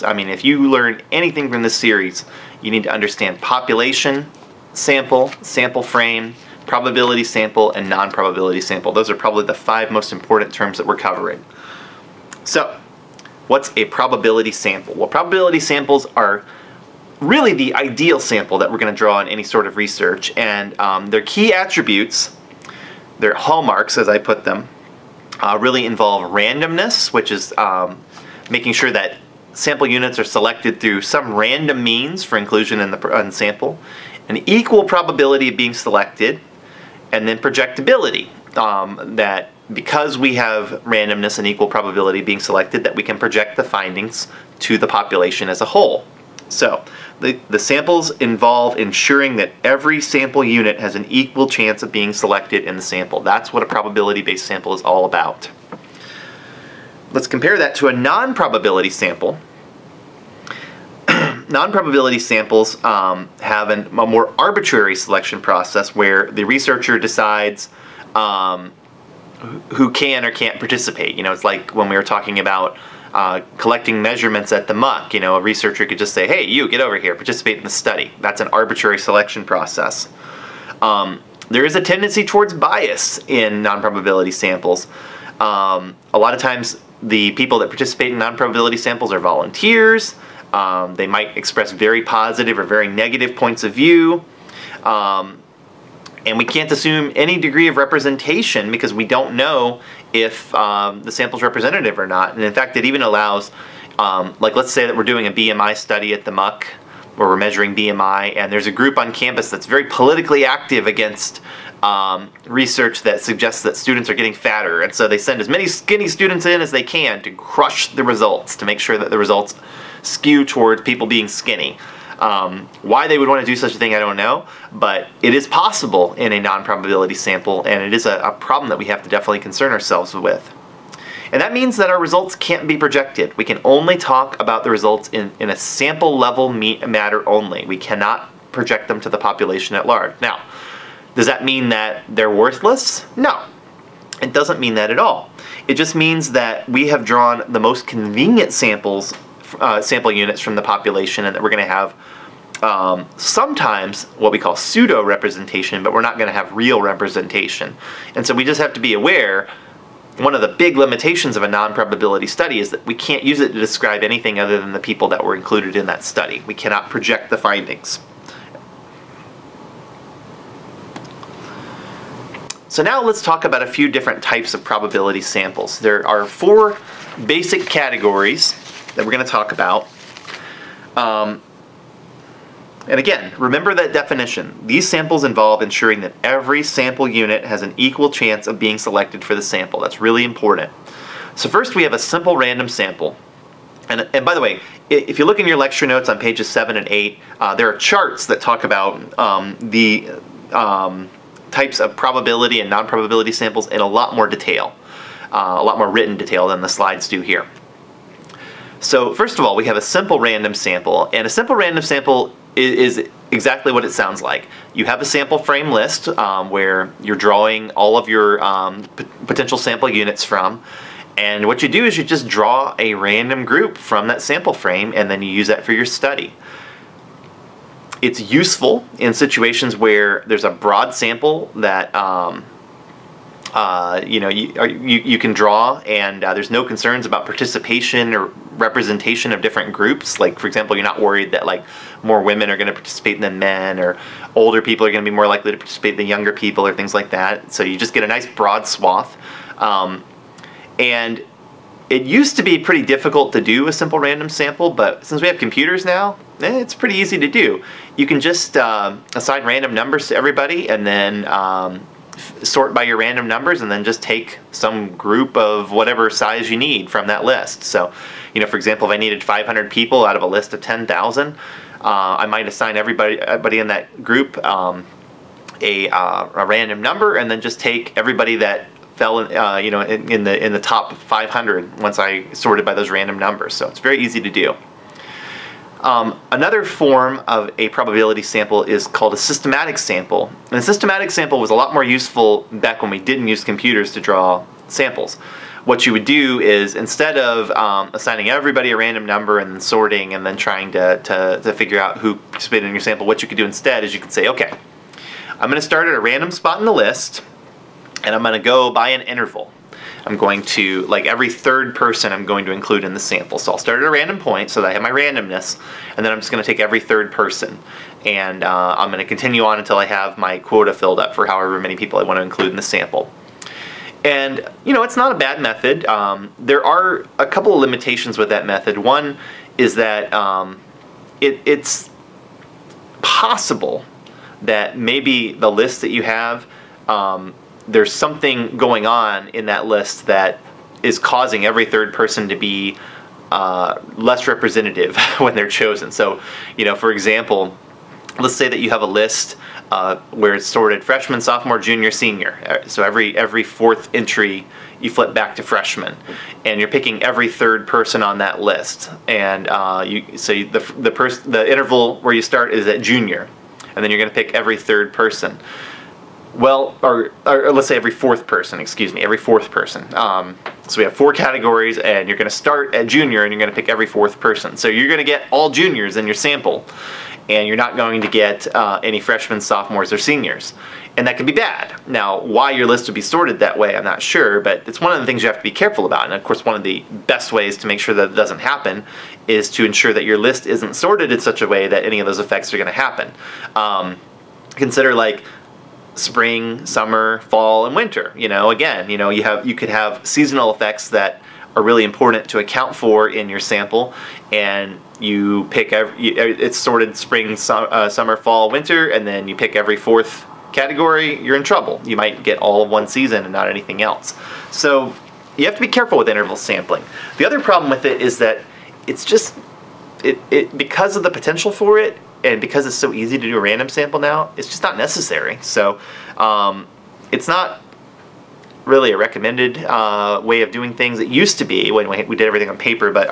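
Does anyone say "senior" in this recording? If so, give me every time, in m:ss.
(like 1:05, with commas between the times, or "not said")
5:51, 6:19.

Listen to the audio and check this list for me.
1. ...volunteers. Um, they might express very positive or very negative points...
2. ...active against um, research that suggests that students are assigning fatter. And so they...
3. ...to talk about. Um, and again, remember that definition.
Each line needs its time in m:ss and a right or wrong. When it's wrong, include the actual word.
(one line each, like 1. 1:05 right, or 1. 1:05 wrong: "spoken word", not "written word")
1. 1:29 right
2. 1:50 wrong: "getting", not "assigning"
3. 2:59 right.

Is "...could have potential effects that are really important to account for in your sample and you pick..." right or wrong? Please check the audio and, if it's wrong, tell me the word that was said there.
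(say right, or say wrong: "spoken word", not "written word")
wrong: "seasonal", not "potential".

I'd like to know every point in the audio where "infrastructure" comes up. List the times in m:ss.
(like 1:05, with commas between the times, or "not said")
not said.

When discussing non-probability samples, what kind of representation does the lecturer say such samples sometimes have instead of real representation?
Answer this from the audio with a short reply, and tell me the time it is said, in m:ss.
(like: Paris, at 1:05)
pseudo representation, at 2:34.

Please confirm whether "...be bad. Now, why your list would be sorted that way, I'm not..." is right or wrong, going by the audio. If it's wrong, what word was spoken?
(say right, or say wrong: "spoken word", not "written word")
right.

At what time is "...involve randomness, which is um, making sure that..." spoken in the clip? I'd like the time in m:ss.
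0:25.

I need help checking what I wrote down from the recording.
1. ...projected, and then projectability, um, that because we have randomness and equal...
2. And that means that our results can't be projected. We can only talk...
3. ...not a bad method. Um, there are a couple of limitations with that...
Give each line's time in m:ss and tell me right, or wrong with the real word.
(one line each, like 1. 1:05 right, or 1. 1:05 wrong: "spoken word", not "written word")
1. 0:35 wrong: "selected", not "projected"
2. 2:11 right
3. 5:24 right.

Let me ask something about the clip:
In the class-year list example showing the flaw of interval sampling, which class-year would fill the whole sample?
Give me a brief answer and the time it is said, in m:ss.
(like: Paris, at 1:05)
juniors, at 6:15.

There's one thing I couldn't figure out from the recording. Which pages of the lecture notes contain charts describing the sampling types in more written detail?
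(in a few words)
pages 7 and 8.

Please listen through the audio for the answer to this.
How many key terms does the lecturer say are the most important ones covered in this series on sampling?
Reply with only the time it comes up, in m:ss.
0:09.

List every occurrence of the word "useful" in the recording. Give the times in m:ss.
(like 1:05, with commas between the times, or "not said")
3:48, 4:51.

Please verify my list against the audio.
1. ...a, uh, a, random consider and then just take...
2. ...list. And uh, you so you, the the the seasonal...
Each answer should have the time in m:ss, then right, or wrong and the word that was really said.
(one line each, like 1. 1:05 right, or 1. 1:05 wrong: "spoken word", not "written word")
1. 4:35 wrong: "number", not "consider"
2. 5:58 wrong: "interval", not "seasonal".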